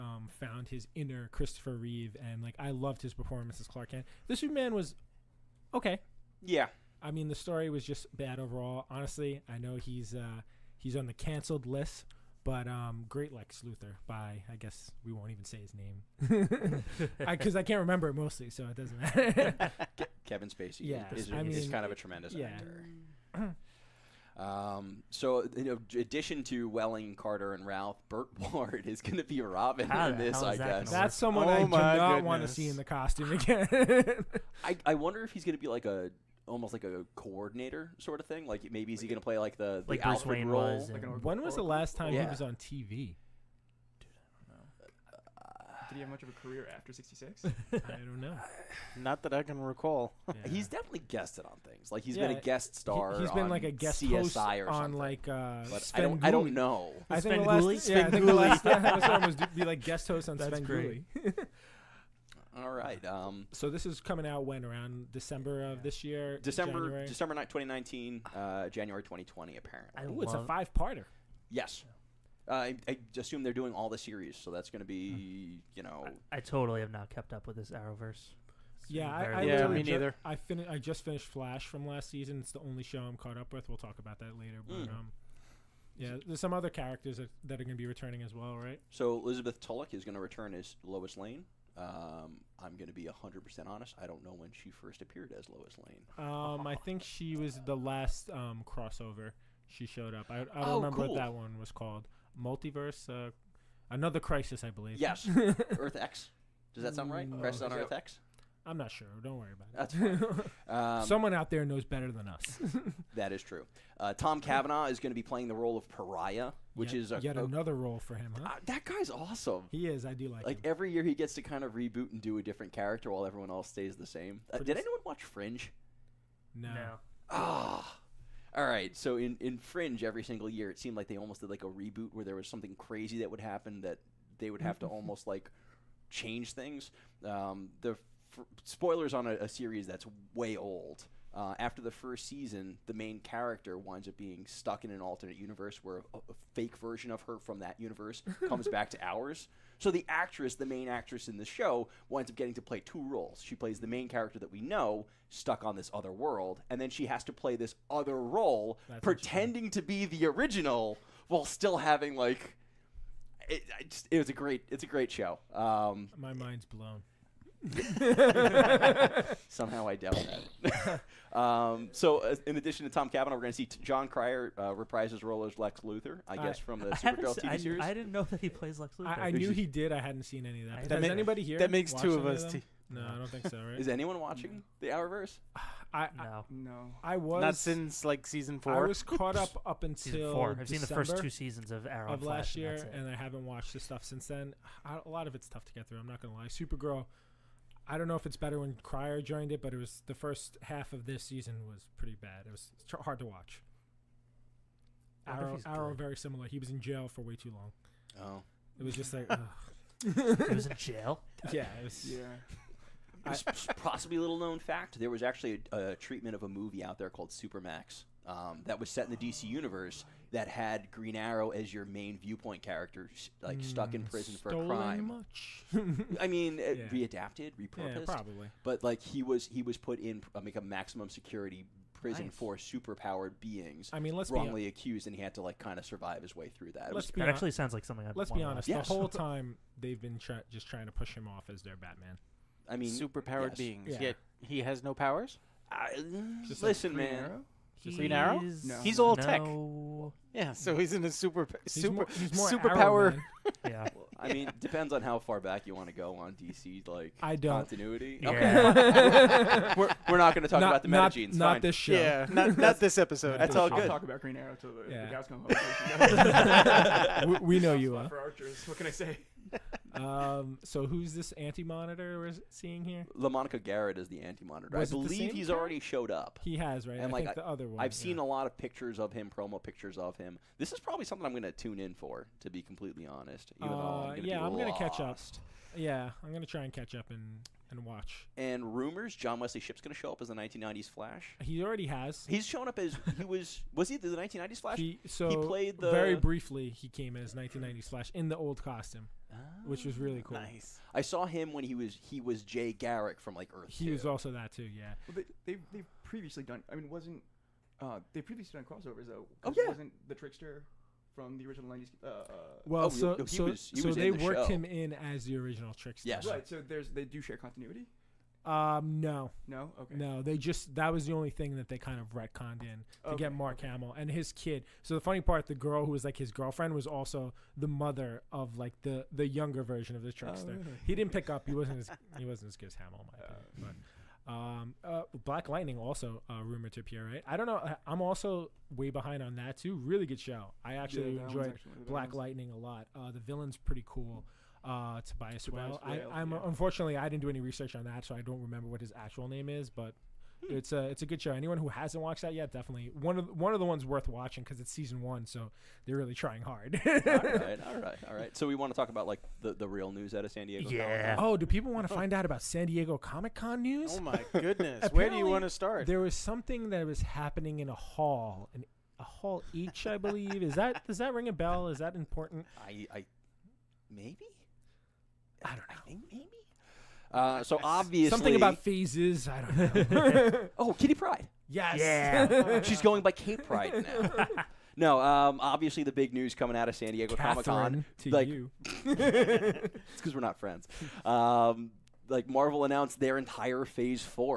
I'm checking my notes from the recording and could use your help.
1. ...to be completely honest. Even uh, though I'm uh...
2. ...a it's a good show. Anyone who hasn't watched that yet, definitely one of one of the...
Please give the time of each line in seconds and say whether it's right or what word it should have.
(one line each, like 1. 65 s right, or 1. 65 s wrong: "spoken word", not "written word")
1. 282 s right
2. 350 s right.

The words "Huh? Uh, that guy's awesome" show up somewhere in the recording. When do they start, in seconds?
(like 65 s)
118 s.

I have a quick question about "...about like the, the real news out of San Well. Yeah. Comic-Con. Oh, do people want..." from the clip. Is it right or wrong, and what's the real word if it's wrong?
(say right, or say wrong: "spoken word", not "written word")
wrong: "Diego", not "Well".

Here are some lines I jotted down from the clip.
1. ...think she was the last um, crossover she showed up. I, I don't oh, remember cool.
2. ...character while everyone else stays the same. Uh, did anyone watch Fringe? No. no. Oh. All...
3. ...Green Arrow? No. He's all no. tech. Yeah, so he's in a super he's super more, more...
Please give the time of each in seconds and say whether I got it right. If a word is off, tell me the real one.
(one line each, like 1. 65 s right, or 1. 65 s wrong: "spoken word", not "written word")
1. 96 s right
2. 122 s right
3. 247 s right.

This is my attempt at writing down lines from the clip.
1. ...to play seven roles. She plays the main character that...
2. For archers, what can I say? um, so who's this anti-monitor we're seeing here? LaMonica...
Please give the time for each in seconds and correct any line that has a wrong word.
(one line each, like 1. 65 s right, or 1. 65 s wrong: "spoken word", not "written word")
1. 152 s wrong: "two", not "seven"
2. 268 s right.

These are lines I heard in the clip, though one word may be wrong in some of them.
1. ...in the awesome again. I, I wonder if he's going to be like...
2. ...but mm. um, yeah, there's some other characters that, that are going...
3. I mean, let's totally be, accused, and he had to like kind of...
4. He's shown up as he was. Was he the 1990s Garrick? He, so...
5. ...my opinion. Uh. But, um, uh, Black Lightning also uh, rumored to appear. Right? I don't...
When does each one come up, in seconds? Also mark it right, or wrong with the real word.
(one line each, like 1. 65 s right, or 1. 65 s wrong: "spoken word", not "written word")
1. 32 s wrong: "costume", not "awesome"
2. 84 s right
3. 233 s wrong: "wrongly", not "totally"
4. 292 s wrong: "Flash", not "Garrick"
5. 333 s right.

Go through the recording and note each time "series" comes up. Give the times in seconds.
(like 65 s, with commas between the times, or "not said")
73 s, 139 s, 177 s.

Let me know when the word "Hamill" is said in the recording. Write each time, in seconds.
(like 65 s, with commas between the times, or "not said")
323 s, 332 s.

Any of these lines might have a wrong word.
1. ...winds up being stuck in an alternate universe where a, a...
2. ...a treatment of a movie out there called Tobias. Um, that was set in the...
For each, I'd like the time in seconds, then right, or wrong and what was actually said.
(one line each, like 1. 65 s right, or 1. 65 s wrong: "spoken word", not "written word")
1. 143 s right
2. 215 s wrong: "Supermax", not "Tobias".